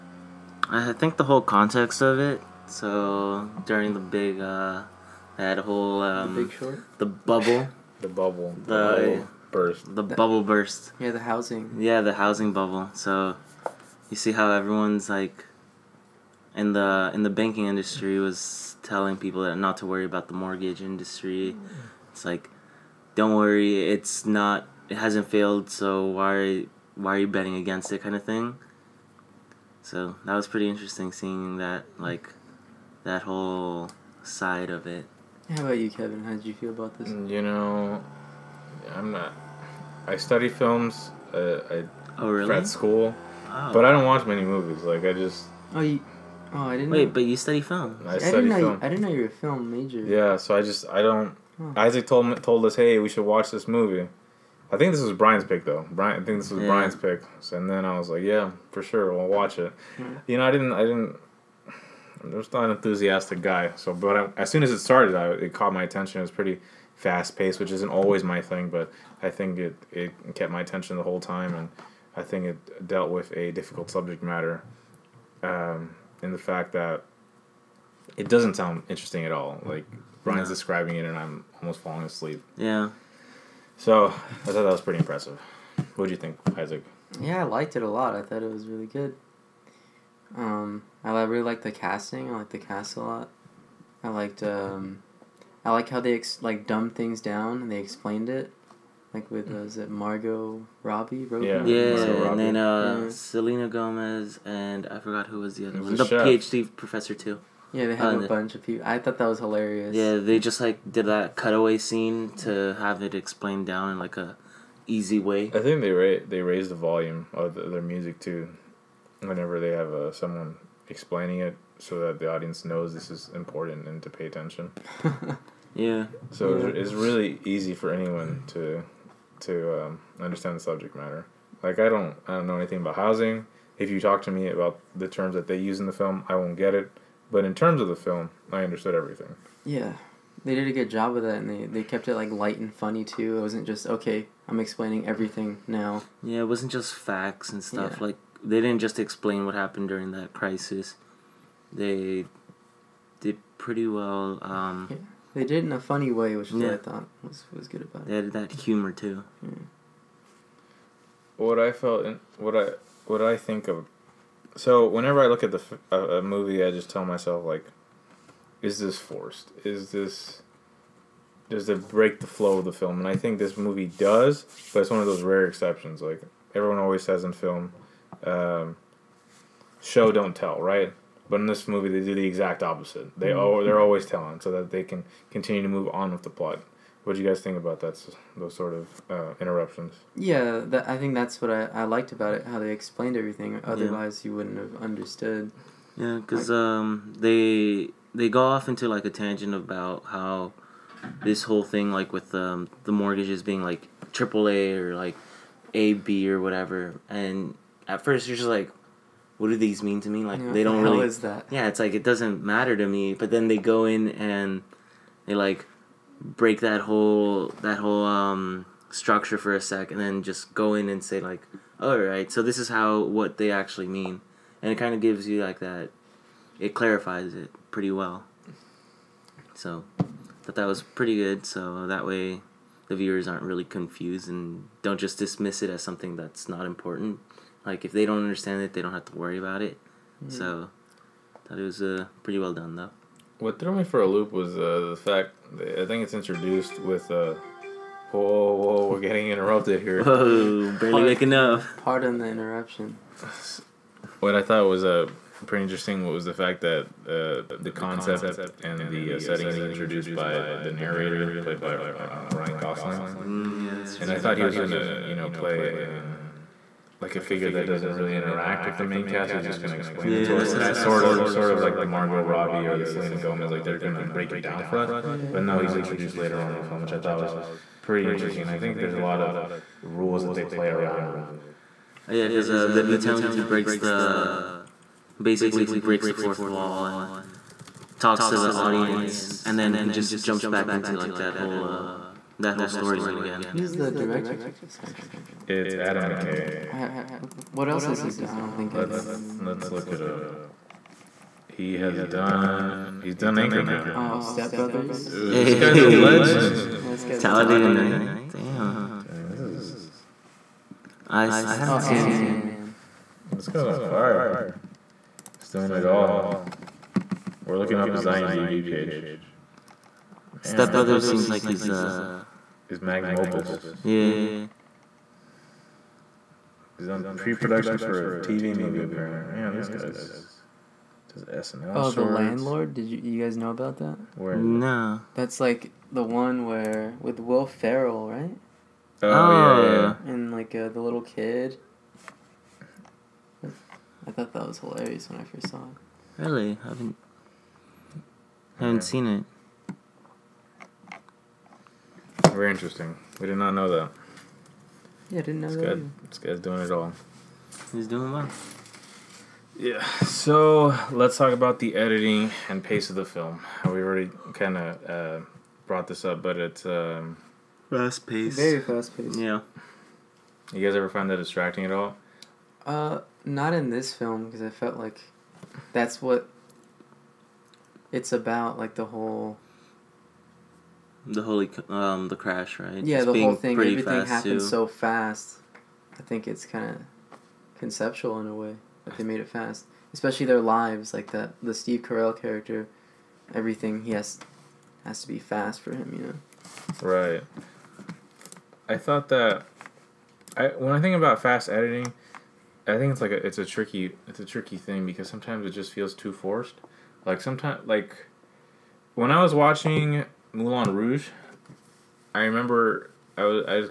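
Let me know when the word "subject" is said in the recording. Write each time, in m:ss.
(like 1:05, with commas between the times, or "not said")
1:13, 2:10.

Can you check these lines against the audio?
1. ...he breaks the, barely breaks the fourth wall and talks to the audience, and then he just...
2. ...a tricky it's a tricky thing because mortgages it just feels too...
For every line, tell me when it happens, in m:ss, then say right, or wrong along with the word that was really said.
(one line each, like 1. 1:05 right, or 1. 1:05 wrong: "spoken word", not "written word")
1. 4:43 wrong: "basically", not "barely"
2. 6:43 wrong: "sometimes", not "mortgages".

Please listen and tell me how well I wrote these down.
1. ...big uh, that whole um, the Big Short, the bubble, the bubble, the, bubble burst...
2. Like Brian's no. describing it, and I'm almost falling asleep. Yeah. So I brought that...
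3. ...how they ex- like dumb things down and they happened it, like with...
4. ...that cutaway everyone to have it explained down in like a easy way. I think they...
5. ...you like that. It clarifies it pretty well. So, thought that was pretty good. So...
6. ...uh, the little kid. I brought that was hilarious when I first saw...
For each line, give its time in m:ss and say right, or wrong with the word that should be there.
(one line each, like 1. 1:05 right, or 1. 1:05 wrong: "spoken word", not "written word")
1. 0:03 right
2. 1:19 wrong: "thought", not "brought"
3. 1:35 wrong: "explained", not "happened"
4. 1:51 wrong: "scene", not "everyone"
5. 3:45 right
6. 5:40 wrong: "thought", not "brought".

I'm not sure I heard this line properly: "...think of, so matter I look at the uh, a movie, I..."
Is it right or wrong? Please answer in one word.
wrong.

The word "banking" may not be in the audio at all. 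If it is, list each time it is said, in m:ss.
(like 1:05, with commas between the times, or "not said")
0:17.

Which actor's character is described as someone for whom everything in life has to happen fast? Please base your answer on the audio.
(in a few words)
Steve Carell.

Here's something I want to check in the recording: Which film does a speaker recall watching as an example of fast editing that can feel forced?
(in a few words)
Moulin Rouge.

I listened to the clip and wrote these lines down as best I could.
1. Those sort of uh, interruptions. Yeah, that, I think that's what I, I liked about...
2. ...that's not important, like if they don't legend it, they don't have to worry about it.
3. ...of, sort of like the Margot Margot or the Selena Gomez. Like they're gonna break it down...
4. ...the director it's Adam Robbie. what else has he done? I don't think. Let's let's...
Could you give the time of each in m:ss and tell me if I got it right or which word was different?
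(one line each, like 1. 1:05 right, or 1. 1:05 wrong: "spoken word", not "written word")
1. 3:08 right
2. 3:56 wrong: "understand", not "legend"
3. 4:31 wrong: "Robbie", not "Margot"
4. 4:53 wrong: "McKay", not "Robbie".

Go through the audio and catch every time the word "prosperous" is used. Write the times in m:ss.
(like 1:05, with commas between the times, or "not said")
not said.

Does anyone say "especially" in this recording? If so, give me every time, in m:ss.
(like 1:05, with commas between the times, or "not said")
6:29.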